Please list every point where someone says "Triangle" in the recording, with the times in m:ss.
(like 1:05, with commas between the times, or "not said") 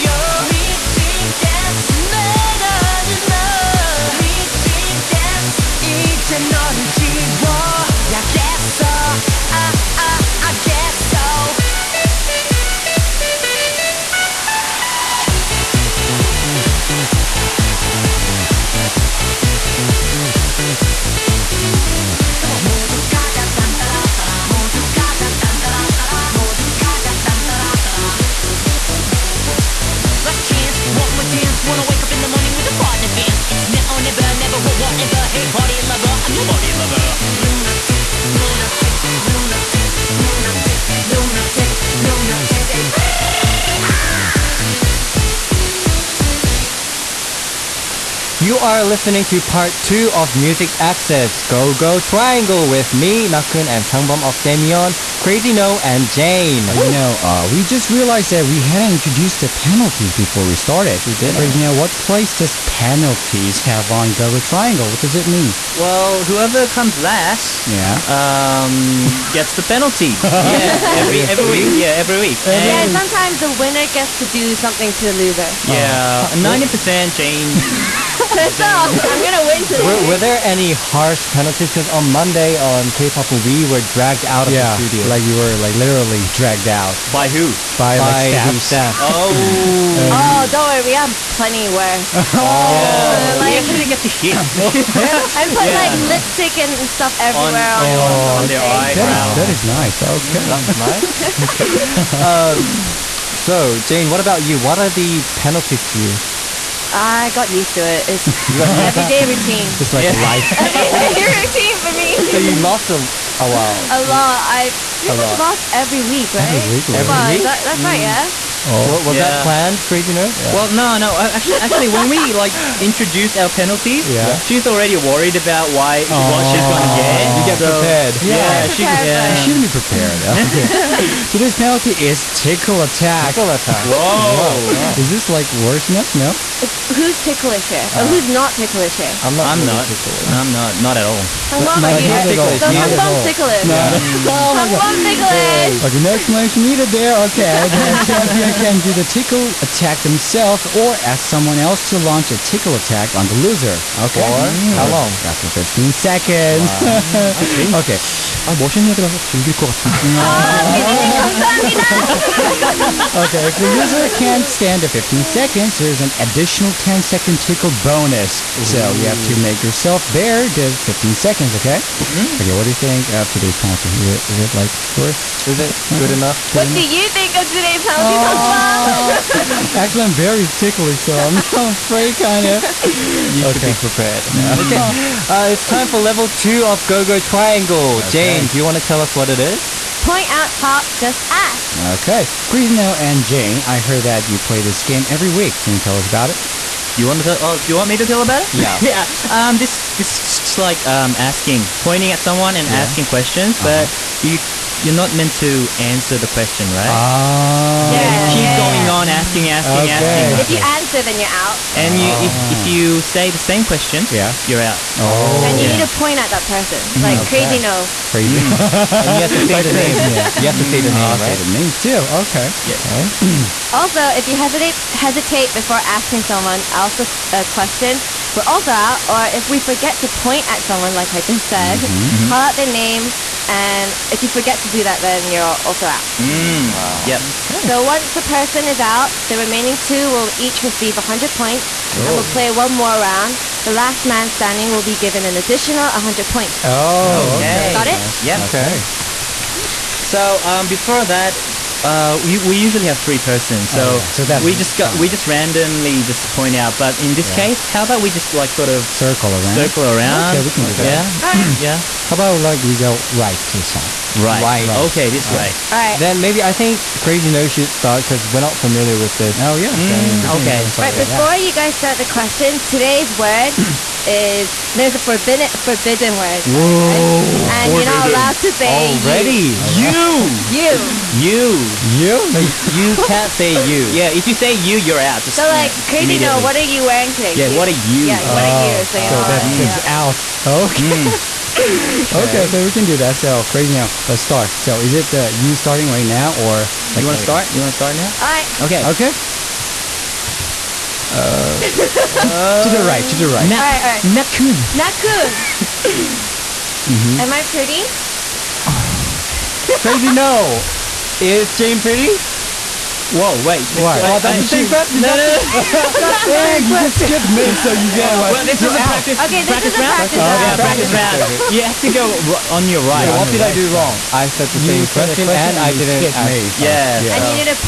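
0:51, 1:04, 3:07.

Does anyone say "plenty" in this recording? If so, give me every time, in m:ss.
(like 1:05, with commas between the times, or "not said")
1:31.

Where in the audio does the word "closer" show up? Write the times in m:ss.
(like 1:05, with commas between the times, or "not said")
not said.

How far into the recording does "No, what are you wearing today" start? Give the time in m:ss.
4:46.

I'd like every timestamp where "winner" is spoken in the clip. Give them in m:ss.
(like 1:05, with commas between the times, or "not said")
1:13.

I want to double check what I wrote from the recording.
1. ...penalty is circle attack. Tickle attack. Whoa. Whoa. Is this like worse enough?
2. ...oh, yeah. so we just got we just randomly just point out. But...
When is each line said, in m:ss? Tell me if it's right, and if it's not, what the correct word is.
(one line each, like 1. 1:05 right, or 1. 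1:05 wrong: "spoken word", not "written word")
1. 2:11 wrong: "tickle", not "circle"
2. 4:14 right.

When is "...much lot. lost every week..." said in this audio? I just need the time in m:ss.
1:55.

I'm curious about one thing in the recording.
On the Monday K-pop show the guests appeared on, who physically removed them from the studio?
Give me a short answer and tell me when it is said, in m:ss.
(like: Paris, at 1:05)
The staff, at 1:27.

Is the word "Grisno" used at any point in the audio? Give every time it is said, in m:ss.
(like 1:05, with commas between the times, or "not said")
3:12.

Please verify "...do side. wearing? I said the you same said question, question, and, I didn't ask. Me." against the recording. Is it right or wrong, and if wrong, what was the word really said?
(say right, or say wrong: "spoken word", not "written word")
wrong: "wrong", not "wearing".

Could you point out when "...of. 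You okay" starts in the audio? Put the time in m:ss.
3:02.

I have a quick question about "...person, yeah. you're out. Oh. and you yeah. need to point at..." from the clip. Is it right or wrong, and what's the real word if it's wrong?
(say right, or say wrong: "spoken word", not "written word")
wrong: "question", not "person".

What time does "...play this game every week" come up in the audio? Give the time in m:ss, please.
3:14.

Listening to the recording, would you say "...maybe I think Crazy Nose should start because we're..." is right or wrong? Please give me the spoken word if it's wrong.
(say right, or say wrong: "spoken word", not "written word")
right.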